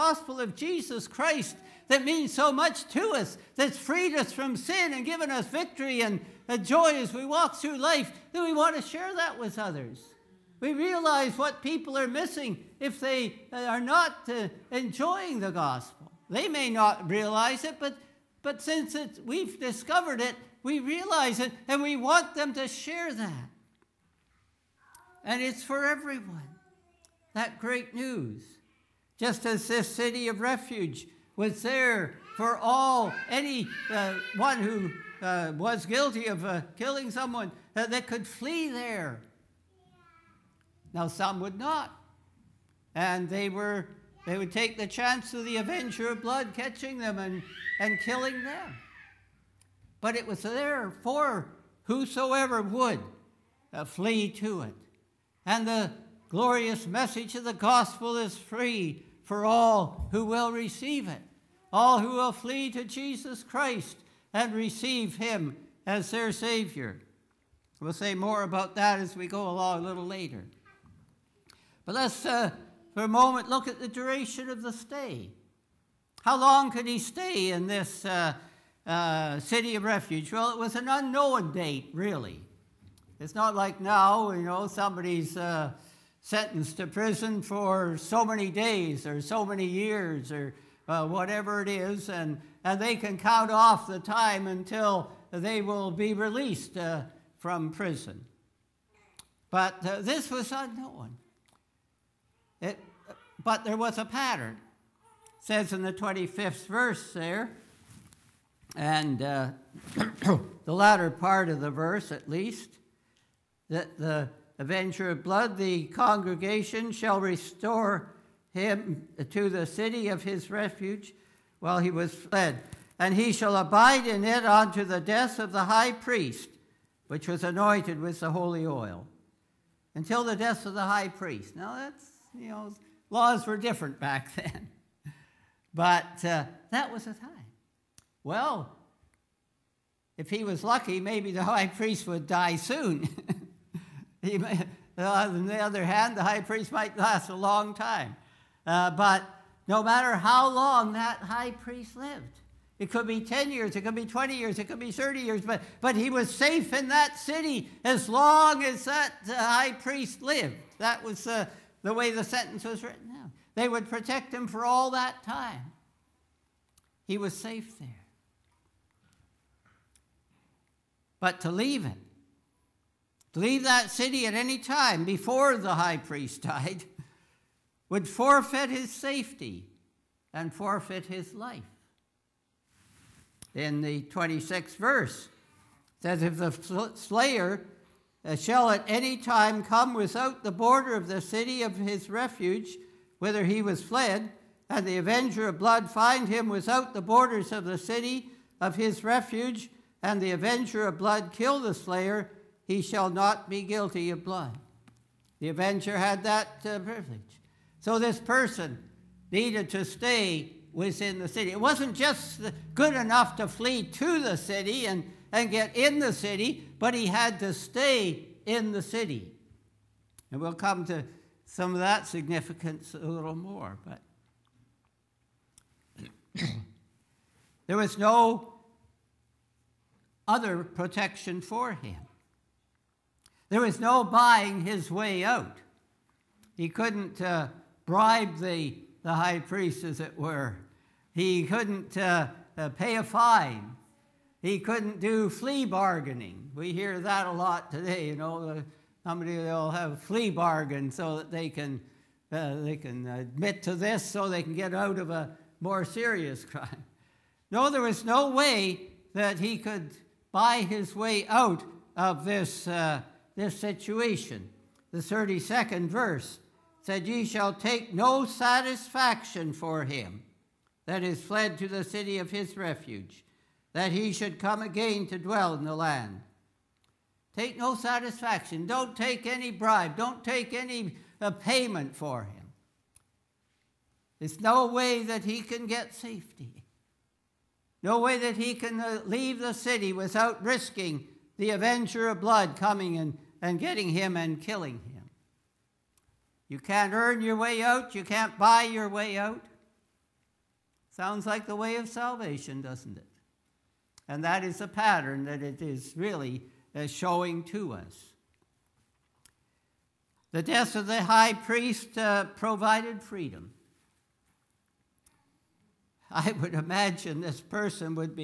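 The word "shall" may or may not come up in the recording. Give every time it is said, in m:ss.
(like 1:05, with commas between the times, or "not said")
1:56, 2:03, 3:08, 3:22, 4:27.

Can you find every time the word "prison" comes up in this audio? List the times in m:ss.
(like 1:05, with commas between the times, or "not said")
1:26, 1:37.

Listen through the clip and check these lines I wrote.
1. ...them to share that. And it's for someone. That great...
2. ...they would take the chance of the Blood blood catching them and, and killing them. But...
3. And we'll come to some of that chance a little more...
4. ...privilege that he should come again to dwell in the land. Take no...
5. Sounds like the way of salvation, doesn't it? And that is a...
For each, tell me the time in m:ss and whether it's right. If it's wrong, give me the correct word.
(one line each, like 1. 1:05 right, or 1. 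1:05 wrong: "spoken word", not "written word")
1. 0:22 wrong: "everyone", not "someone"
2. 0:44 wrong: "Avenger", not "Blood"
3. 3:40 wrong: "significance", not "chance"
4. 4:32 wrong: "refuge", not "privilege"
5. 5:00 right.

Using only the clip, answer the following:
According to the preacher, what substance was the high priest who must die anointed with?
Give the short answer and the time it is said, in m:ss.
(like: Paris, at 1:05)
holy oil, at 2:08.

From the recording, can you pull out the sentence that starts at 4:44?
There's no way that he can get safety.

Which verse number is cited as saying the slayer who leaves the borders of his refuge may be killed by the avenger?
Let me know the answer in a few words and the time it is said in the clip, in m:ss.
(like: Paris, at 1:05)
26th, at 3:04.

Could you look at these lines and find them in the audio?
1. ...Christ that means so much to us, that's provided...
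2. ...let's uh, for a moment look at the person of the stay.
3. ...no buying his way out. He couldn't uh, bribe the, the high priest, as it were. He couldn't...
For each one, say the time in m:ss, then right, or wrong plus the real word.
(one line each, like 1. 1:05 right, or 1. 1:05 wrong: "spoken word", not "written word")
1. 0:01 wrong: "freed", not "provided"
2. 1:11 wrong: "duration", not "person"
3. 3:53 right.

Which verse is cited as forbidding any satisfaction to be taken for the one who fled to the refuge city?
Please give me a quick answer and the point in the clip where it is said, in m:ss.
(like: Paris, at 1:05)
32nd, at 4:24.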